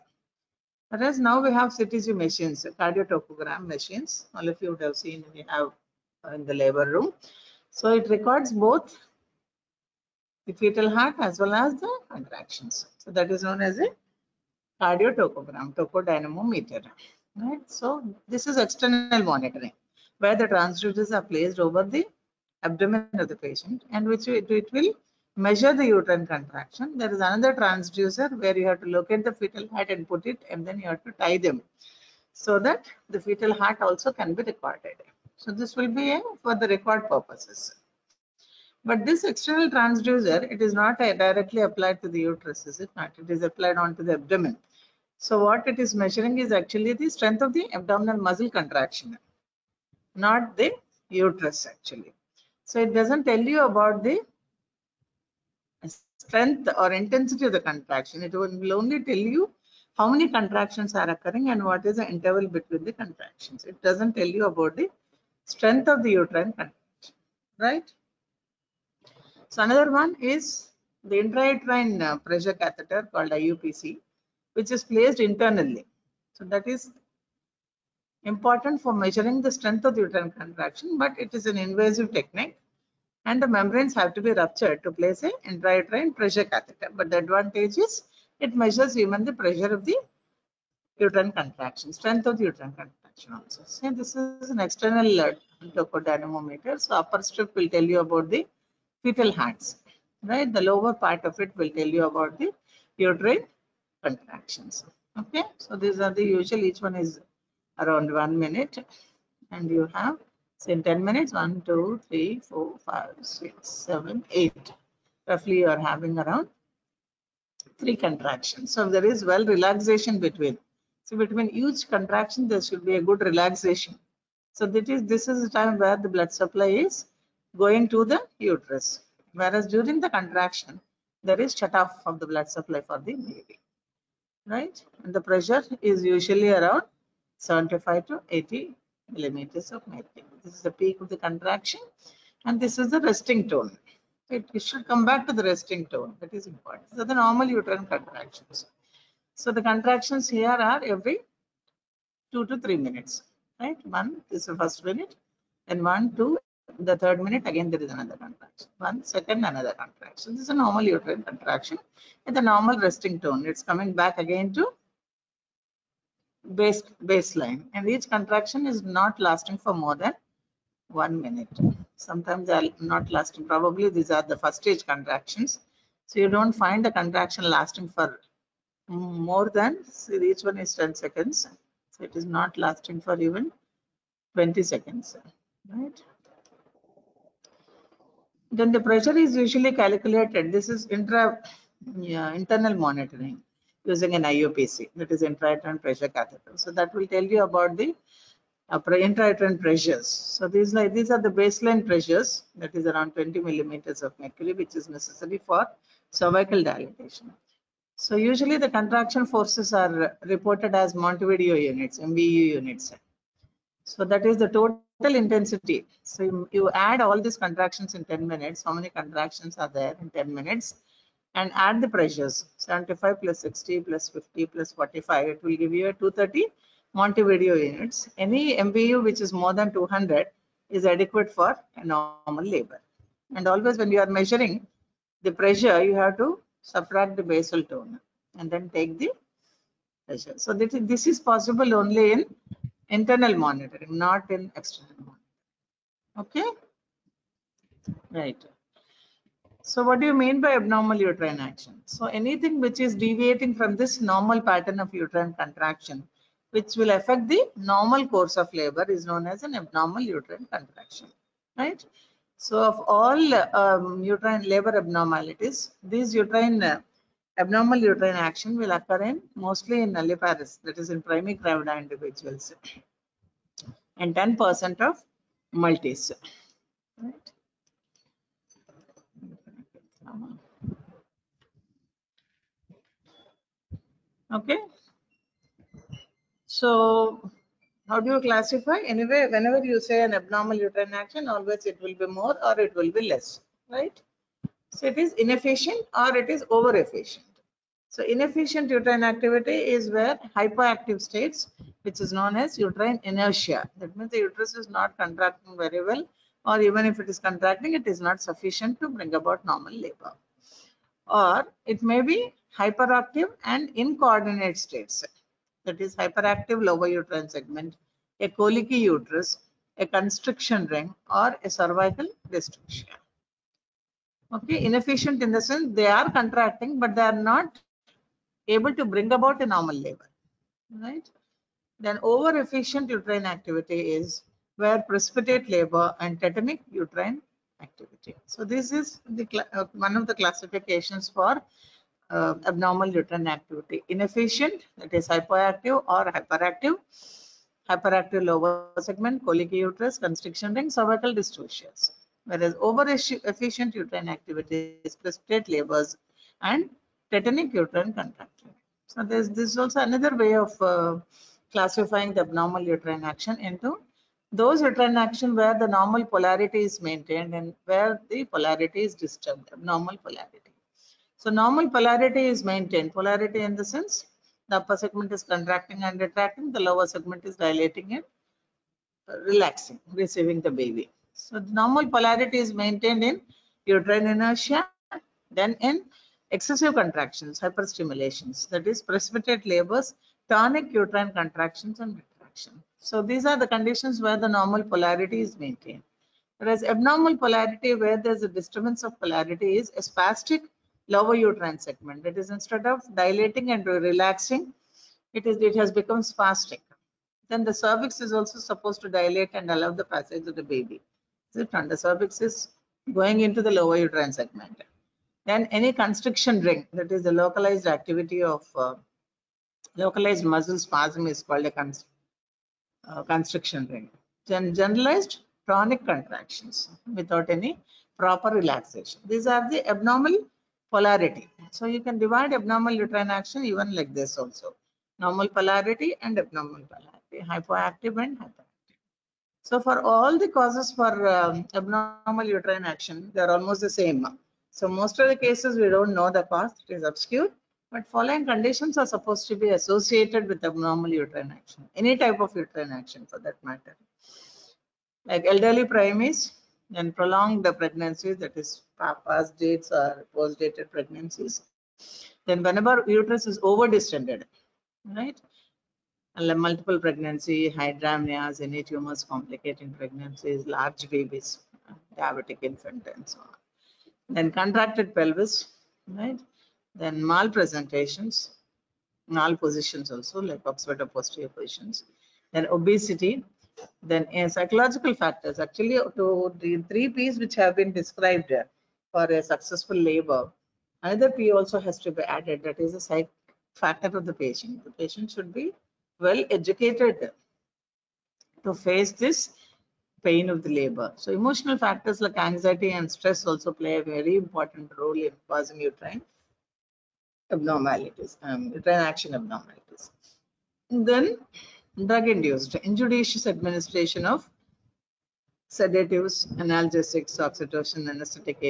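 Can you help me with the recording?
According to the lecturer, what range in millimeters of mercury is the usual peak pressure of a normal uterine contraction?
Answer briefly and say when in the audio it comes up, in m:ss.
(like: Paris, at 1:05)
75 to 80, at 2:17.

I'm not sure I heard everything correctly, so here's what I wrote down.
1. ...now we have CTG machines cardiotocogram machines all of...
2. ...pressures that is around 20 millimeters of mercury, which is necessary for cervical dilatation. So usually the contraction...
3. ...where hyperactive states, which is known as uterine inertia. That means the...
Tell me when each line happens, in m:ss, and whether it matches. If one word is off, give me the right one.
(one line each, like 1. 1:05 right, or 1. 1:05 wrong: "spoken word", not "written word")
1. 0:01 right
2. 3:21 right
3. 4:59 right.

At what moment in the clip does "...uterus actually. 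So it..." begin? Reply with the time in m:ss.
0:51.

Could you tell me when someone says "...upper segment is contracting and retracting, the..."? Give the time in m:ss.
6:14.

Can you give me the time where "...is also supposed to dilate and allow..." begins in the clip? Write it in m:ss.
6:48.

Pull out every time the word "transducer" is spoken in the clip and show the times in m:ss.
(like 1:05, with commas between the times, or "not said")
0:20, 0:27, 0:39.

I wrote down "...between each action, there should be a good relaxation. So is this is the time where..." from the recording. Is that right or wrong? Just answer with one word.
wrong.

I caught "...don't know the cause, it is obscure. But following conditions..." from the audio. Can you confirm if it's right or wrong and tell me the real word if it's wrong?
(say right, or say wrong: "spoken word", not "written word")
right.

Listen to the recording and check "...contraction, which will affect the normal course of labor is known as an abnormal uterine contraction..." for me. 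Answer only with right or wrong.
right.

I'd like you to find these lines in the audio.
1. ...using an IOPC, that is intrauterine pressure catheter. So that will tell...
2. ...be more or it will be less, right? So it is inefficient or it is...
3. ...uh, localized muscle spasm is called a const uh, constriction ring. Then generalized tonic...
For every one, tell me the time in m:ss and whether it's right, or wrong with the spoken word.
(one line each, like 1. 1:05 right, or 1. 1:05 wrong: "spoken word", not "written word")
1. 3:13 right
2. 4:51 right
3. 6:58 right.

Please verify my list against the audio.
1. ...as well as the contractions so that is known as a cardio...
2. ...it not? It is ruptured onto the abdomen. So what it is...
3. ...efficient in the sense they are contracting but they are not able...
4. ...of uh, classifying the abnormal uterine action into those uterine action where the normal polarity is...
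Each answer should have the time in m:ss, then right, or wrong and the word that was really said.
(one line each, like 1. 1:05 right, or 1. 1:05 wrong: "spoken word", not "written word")
1. 0:11 right
2. 0:42 wrong: "applied", not "ruptured"
3. 5:24 wrong: "inefficient", not "efficient"
4. 6:00 right.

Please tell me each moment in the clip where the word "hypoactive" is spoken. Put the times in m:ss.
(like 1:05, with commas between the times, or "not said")
5:45, 7:17.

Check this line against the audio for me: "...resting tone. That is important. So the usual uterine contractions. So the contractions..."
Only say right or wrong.
wrong.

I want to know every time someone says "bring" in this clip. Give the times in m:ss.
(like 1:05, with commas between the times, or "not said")
5:08, 5:28.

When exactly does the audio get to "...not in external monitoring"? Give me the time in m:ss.
4:03.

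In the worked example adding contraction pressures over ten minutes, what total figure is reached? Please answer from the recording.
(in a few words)
230.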